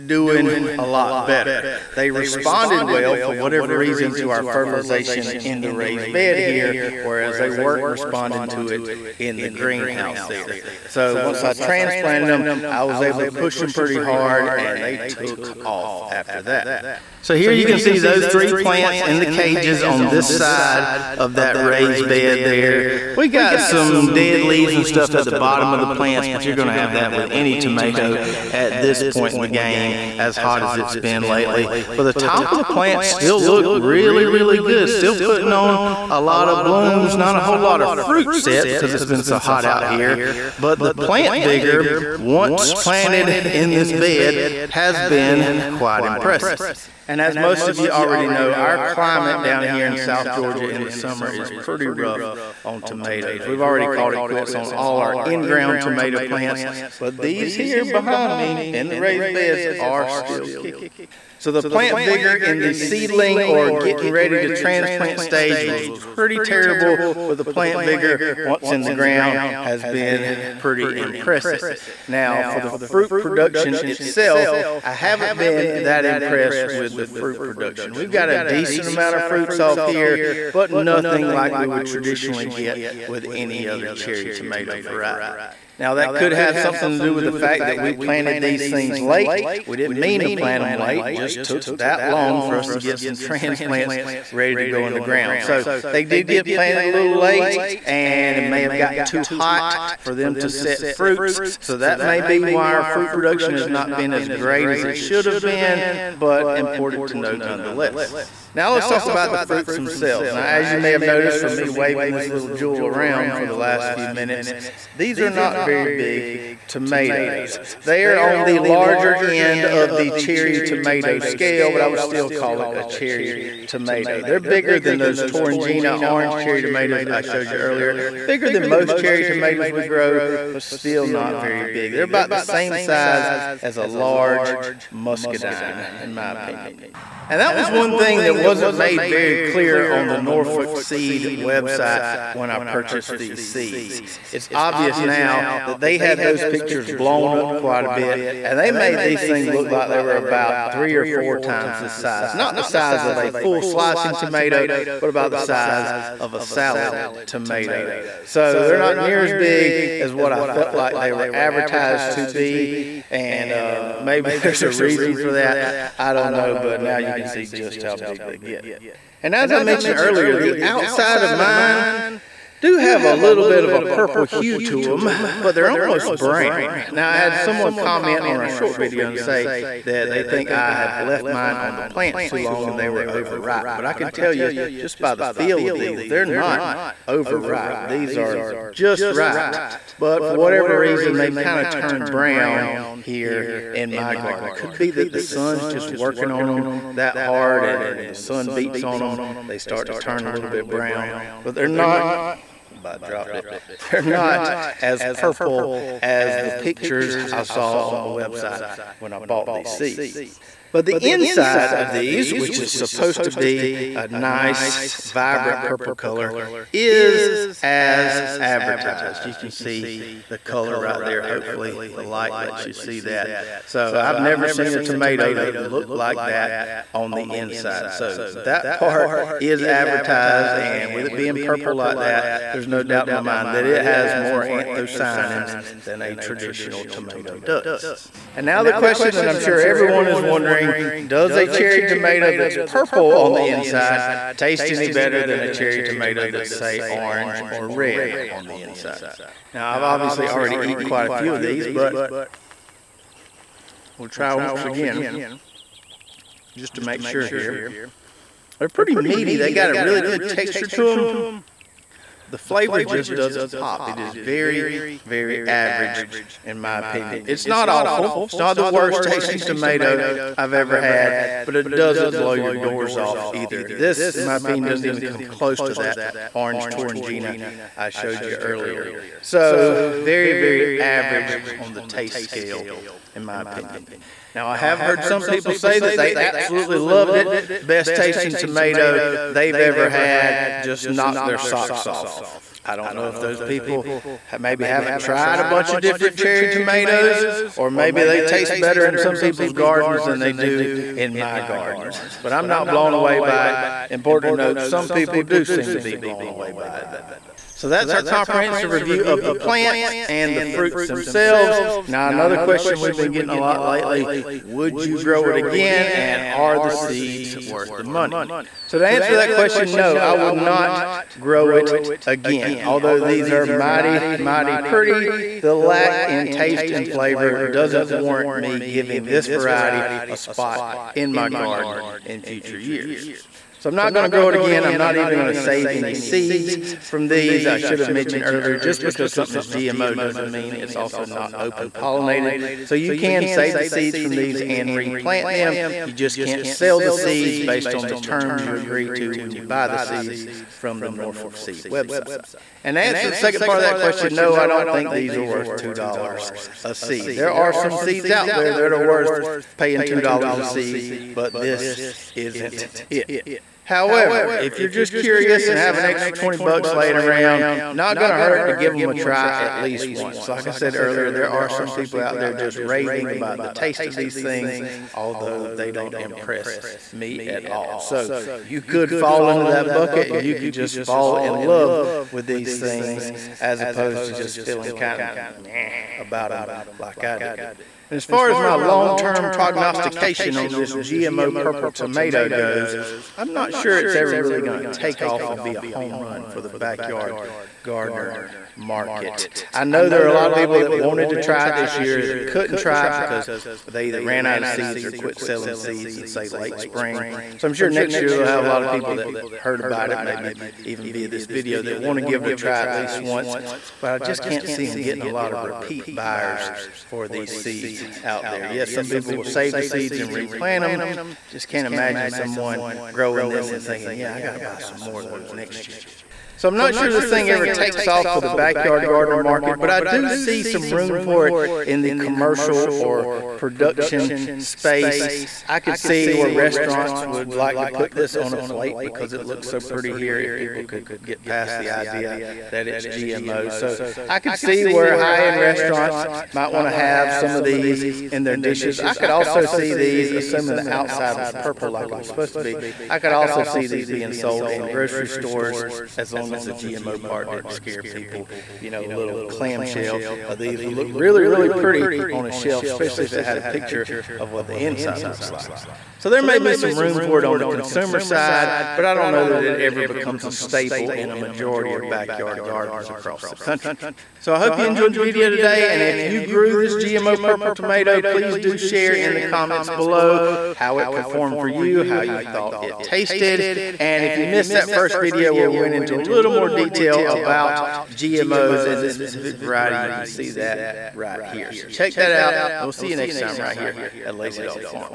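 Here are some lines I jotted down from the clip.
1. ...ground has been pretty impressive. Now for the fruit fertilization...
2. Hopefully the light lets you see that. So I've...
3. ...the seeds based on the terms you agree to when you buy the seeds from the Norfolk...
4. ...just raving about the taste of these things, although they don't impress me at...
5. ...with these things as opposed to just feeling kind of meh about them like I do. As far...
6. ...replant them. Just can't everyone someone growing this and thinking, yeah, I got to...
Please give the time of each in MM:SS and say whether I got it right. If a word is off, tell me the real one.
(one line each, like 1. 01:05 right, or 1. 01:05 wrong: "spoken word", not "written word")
1. 01:08 wrong: "production", not "fertilization"
2. 03:41 right
3. 05:46 right
4. 06:12 right
5. 06:22 right
6. 07:00 wrong: "imagine", not "everyone".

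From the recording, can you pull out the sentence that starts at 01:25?
Now that could have something to do with the fact that we planted these things late.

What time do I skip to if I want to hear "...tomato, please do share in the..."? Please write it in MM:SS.
07:57.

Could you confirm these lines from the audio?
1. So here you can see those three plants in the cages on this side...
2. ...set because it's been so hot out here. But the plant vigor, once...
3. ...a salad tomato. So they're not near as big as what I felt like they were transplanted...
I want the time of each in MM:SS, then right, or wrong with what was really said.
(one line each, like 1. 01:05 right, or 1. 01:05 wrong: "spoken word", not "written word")
1. 00:17 right
2. 00:38 right
3. 02:36 wrong: "advertised", not "transplanted".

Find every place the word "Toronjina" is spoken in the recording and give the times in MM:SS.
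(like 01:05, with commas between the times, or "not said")
02:05, 04:36.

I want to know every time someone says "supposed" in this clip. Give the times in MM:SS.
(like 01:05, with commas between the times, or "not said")
03:32, 07:32.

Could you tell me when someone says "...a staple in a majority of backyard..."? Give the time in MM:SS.
07:50.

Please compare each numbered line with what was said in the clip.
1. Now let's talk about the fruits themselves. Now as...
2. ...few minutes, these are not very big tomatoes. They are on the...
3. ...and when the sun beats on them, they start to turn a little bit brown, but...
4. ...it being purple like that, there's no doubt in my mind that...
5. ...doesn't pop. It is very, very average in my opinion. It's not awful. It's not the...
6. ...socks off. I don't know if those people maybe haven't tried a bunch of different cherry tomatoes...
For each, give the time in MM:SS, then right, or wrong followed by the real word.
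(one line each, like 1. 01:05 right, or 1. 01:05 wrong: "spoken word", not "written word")
1. 01:48 right
2. 01:53 right
3. 03:17 right
4. 03:51 right
5. 04:23 right
6. 04:51 right.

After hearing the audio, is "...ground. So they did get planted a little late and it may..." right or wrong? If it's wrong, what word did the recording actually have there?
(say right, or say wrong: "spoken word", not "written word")
right.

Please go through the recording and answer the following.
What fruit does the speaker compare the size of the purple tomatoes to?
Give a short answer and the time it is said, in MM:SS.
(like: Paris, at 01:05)
large muscadine, at 02:13.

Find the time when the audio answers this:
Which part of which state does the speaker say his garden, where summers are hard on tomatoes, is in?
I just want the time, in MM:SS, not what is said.
00:49.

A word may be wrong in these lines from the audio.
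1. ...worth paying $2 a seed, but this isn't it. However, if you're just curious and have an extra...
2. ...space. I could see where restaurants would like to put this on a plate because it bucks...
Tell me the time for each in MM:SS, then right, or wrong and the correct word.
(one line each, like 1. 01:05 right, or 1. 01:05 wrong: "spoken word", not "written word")
1. 05:58 right
2. 07:14 wrong: "looks", not "bucks".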